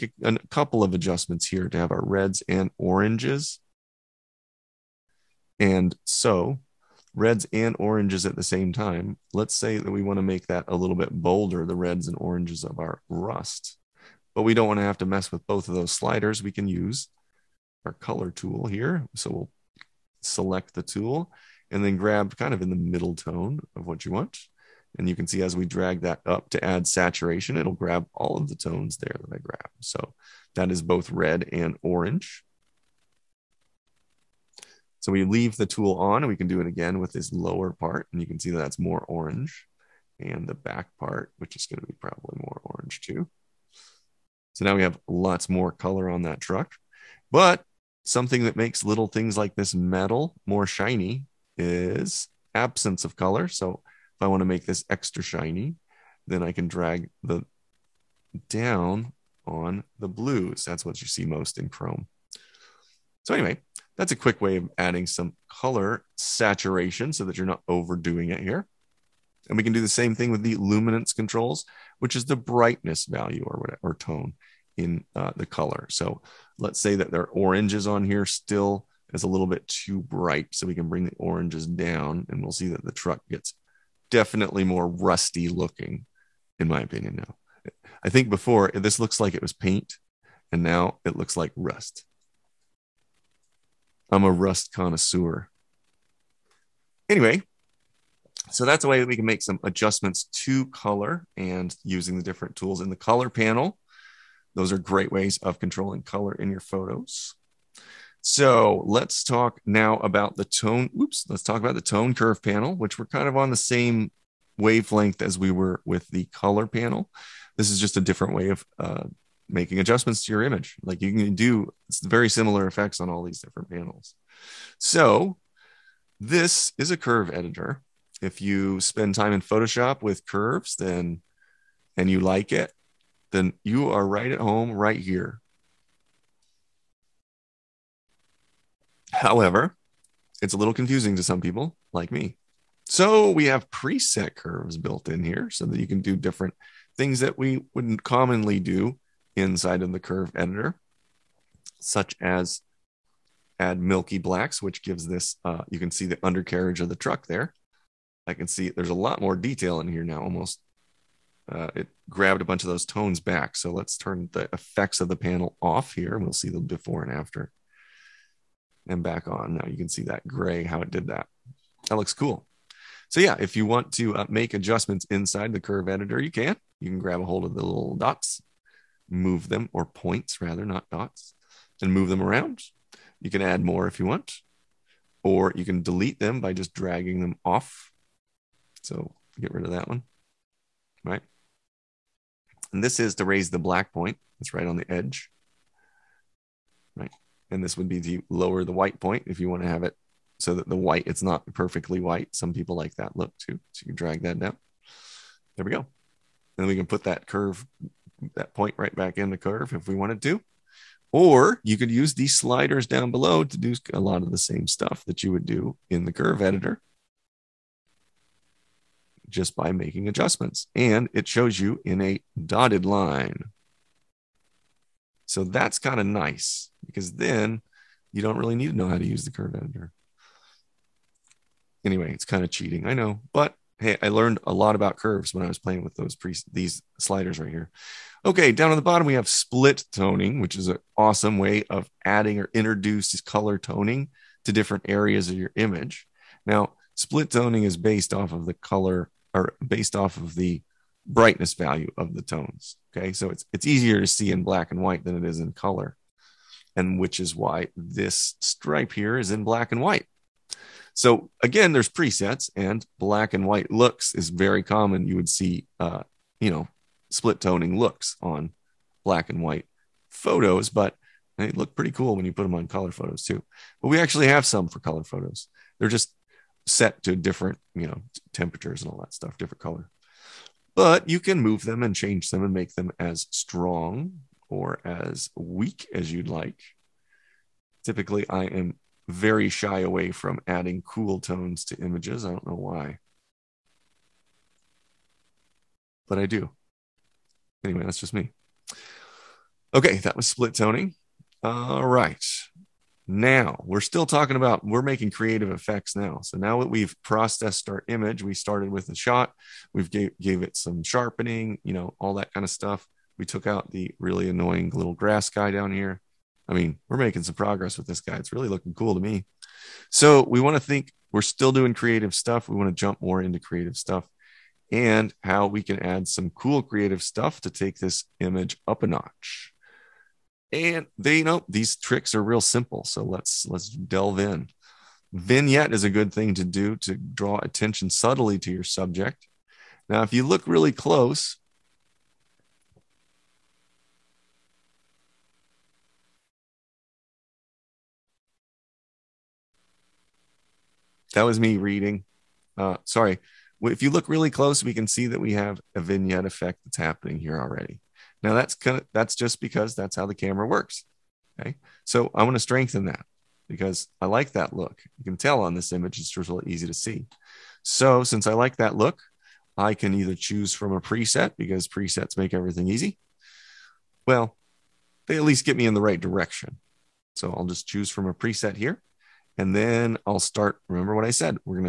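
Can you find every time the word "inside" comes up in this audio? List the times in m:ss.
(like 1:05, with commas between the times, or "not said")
2:29, 2:55.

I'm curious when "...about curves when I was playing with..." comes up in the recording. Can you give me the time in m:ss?
3:54.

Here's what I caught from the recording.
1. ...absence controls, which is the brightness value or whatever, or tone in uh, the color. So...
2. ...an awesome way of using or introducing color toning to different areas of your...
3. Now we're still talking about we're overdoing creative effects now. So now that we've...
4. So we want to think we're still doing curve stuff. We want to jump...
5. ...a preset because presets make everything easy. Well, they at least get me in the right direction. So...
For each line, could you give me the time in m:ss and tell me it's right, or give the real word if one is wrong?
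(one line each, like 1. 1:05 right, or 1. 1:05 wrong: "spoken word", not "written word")
1. 1:10 wrong: "luminance", not "absence"
2. 4:00 wrong: "adding", not "using"
3. 5:03 wrong: "making", not "overdoing"
4. 5:19 wrong: "creative", not "curve"
5. 6:10 right.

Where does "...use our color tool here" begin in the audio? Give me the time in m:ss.
0:16.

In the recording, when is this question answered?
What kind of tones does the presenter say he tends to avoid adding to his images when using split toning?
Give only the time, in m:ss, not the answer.
4:50.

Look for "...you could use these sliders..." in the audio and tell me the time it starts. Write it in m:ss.
3:31.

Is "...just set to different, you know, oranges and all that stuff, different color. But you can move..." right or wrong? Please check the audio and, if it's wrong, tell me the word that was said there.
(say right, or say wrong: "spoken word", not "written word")
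wrong: "temperatures", not "oranges".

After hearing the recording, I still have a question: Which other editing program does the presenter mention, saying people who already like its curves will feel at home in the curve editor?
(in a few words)
Photoshop.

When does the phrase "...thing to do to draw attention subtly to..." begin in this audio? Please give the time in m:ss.
5:36.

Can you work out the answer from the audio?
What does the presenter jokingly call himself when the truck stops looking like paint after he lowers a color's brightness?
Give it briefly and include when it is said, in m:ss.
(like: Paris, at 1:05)
rust connoisseur, at 1:34.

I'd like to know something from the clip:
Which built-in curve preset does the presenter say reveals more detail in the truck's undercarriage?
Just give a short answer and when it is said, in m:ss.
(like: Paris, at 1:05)
milky blacks, at 2:33.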